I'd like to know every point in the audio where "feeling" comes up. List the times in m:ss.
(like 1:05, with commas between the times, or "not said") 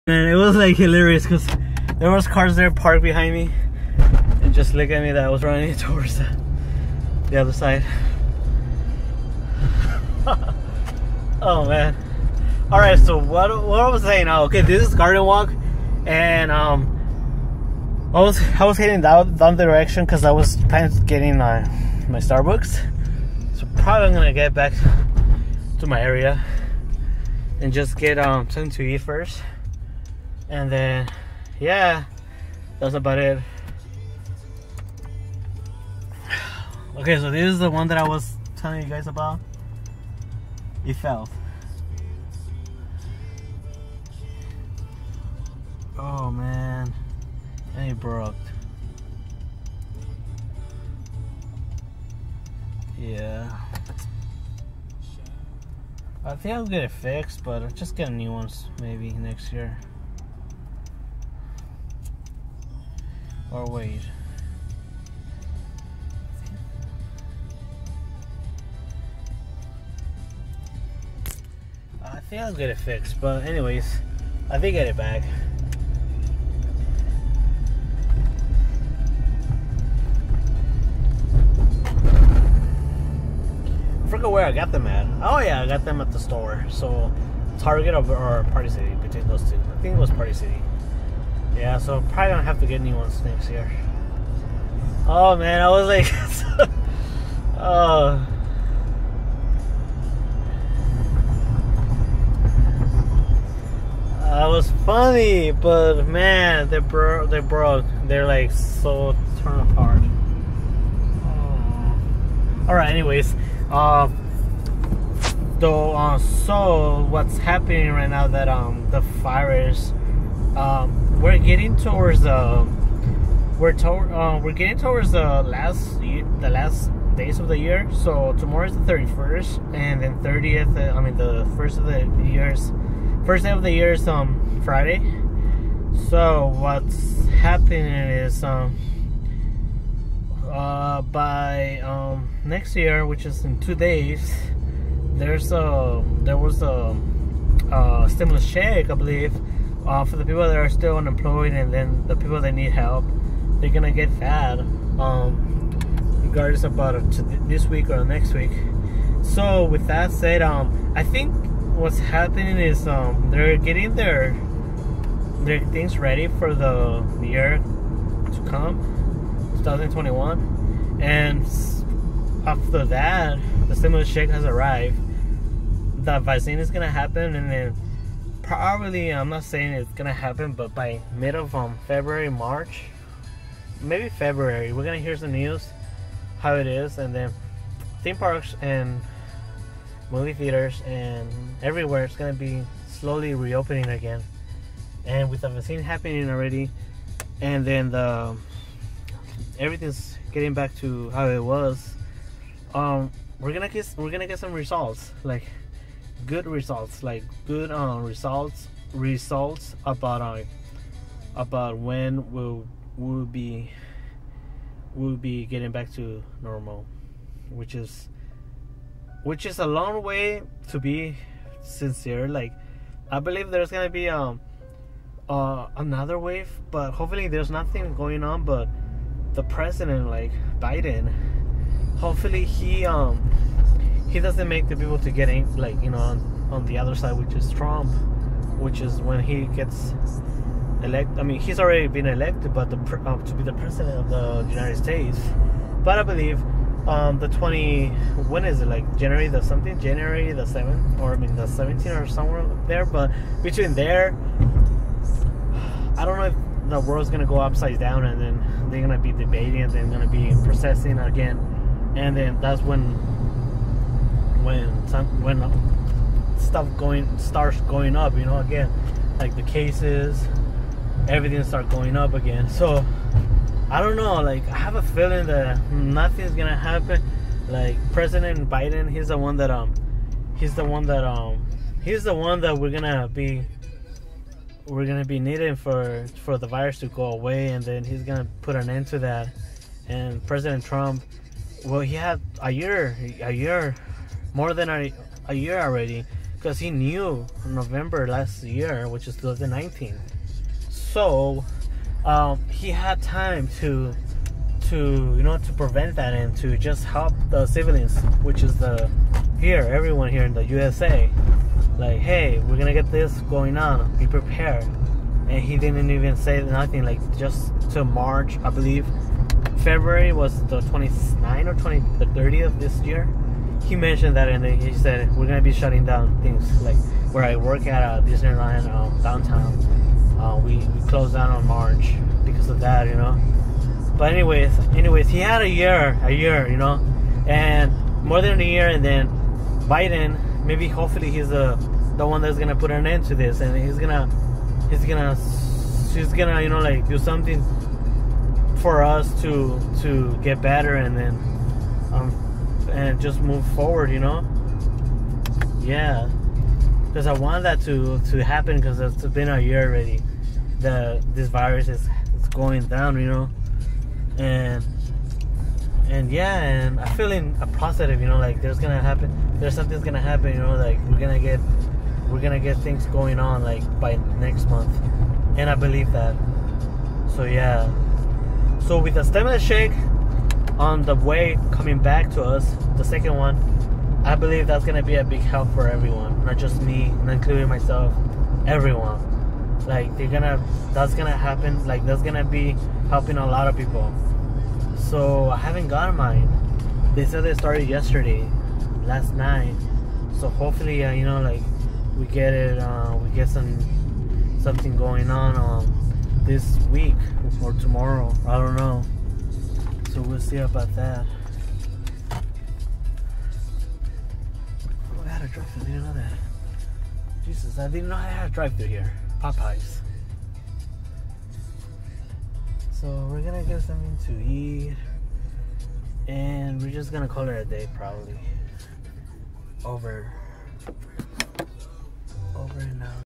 4:34, 6:06.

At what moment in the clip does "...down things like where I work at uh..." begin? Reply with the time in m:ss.
5:25.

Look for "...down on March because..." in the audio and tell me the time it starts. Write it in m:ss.
5:31.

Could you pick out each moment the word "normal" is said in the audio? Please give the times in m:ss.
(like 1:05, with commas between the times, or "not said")
3:36.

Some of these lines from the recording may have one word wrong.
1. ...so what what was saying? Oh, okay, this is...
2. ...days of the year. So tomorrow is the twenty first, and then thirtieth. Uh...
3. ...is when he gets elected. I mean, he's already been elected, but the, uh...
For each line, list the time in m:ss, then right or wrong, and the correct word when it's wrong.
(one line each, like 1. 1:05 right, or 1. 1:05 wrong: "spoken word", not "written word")
1. 0:12 right
2. 2:07 wrong: "thirty", not "twenty"
3. 3:58 right.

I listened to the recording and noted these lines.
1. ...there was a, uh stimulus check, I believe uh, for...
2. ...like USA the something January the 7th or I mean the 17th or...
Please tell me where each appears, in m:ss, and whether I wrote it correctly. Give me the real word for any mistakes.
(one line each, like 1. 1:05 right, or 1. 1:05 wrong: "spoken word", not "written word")
1. 2:26 right
2. 4:08 wrong: "January", not "USA".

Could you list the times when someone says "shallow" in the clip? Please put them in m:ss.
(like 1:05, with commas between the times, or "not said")
not said.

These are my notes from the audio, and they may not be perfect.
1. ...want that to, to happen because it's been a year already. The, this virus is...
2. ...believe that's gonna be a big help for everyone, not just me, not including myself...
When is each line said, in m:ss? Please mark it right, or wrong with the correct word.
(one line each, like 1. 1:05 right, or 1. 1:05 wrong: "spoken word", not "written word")
1. 5:57 right
2. 6:24 right.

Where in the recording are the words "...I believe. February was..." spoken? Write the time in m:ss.
5:18.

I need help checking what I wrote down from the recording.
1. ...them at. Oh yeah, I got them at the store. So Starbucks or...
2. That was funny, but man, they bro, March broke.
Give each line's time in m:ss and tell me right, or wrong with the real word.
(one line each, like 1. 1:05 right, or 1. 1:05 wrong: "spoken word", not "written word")
1. 1:24 wrong: "Target", not "Starbucks"
2. 1:44 wrong: "They", not "March".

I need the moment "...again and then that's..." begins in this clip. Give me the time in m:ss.
4:20.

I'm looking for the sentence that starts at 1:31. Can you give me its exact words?
Yeah, so probably don't have to get any one snakes here.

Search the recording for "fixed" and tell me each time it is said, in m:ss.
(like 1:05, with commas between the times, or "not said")
0:56, 1:12.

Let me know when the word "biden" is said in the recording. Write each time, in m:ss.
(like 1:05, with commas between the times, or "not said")
3:50, 4:38, 5:39.